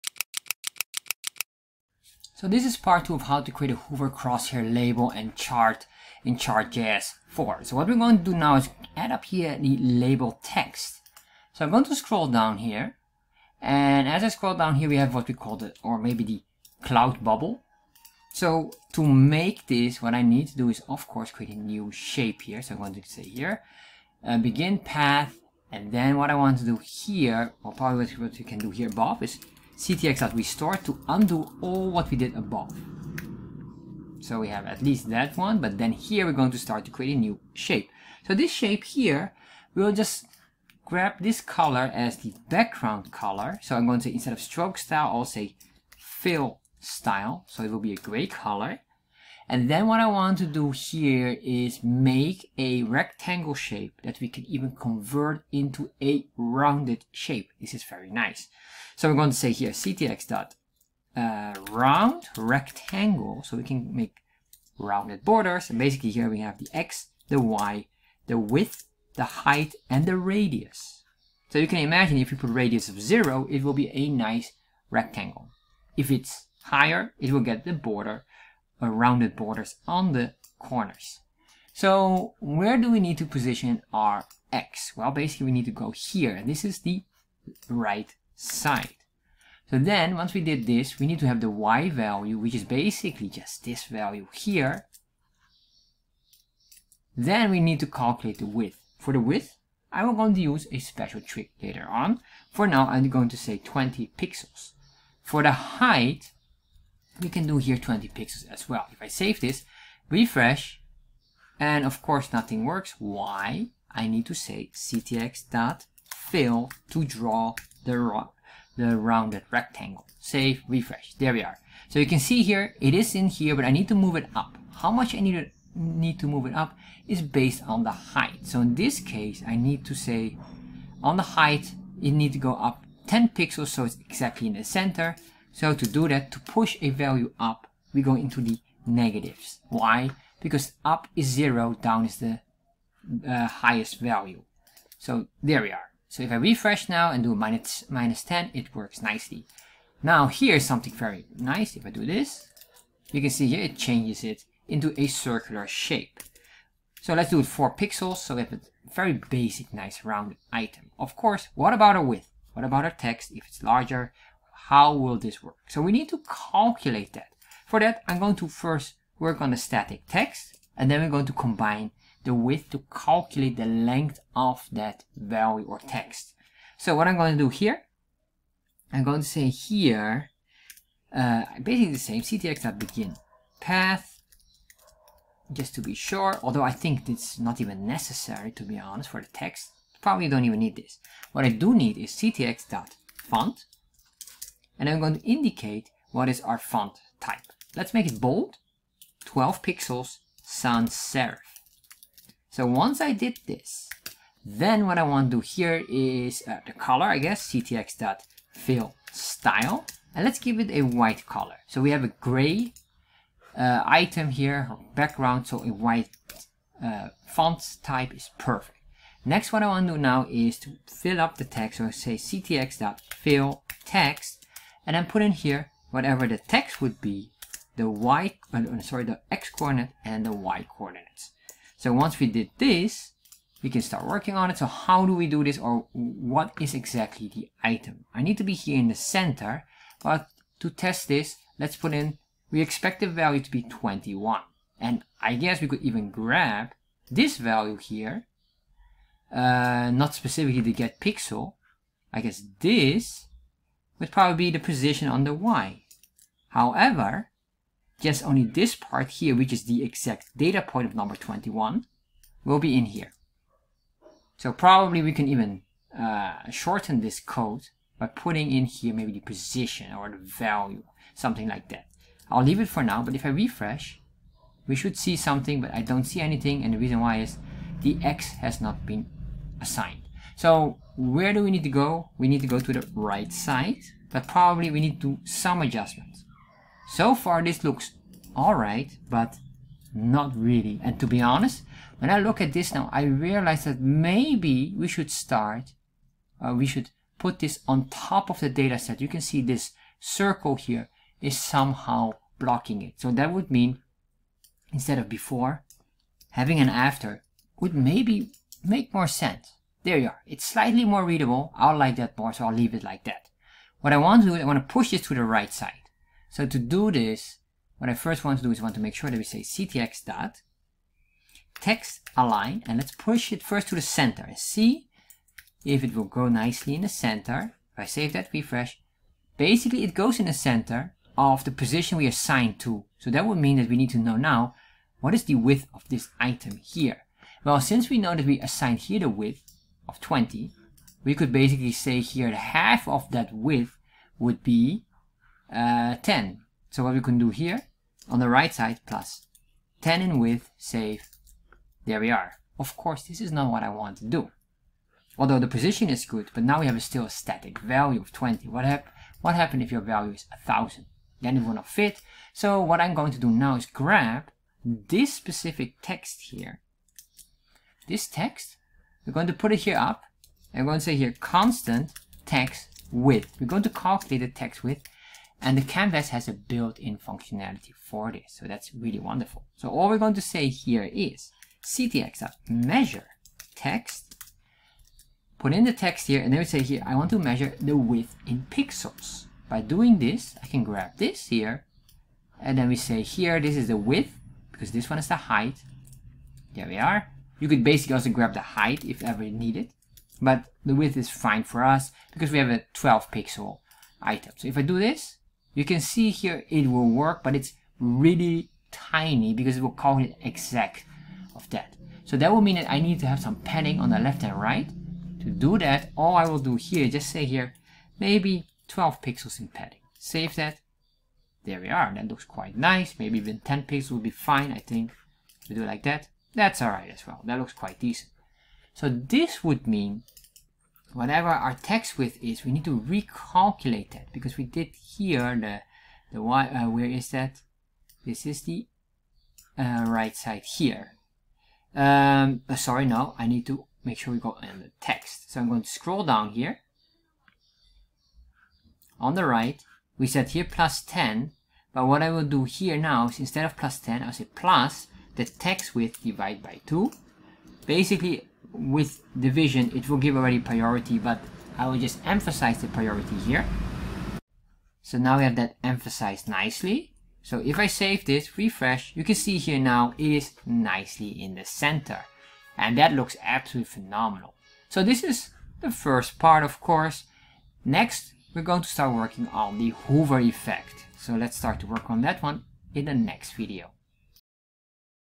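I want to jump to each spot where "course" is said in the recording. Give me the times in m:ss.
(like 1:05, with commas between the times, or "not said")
0:21, 1:52, 2:41, 5:52, 7:56.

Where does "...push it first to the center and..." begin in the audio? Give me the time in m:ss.
5:22.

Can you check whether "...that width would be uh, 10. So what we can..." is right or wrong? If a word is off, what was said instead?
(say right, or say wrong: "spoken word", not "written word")
right.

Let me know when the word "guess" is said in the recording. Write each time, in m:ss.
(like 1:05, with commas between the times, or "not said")
3:27, 4:05, 4:12.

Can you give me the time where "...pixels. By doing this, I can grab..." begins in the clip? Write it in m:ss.
6:28.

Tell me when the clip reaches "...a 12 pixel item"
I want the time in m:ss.
6:42.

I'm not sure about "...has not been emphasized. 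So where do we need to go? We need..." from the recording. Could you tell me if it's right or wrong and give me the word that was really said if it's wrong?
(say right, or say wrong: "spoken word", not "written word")
wrong: "assigned", not "emphasized".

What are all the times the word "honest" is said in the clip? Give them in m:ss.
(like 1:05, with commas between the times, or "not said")
3:08, 4:51.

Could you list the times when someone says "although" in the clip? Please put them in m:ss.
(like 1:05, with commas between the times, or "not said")
3:06, 5:55.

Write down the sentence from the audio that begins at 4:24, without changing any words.
So probably we can even uh, shorten this code by putting in here maybe the position or the value, something like that.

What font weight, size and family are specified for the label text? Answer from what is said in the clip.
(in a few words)
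bold 12 pixels sans serif.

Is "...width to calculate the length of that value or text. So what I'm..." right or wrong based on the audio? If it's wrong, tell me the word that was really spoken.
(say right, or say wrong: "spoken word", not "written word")
right.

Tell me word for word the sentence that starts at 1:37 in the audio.
Then we need to calculate the width.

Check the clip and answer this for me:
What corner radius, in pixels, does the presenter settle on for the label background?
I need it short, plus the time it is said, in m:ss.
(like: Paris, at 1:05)
4 pixels, at 2:37.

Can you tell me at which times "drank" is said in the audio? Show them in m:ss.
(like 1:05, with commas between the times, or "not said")
not said.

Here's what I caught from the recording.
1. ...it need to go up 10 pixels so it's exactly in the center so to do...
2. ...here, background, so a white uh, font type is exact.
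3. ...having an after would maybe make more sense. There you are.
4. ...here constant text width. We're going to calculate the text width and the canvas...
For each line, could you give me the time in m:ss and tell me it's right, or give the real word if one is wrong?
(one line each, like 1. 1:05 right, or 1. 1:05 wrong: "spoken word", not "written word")
1. 2:12 right
2. 3:34 wrong: "perfect", not "exact"
3. 5:06 right
4. 6:10 right.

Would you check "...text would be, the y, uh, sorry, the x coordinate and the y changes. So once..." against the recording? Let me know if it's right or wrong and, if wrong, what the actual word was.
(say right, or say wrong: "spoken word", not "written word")
wrong: "coordinates", not "changes".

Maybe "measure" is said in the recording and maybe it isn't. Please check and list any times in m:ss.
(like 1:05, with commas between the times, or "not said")
6:22, 6:27.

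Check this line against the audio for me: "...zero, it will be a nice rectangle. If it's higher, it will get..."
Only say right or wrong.
right.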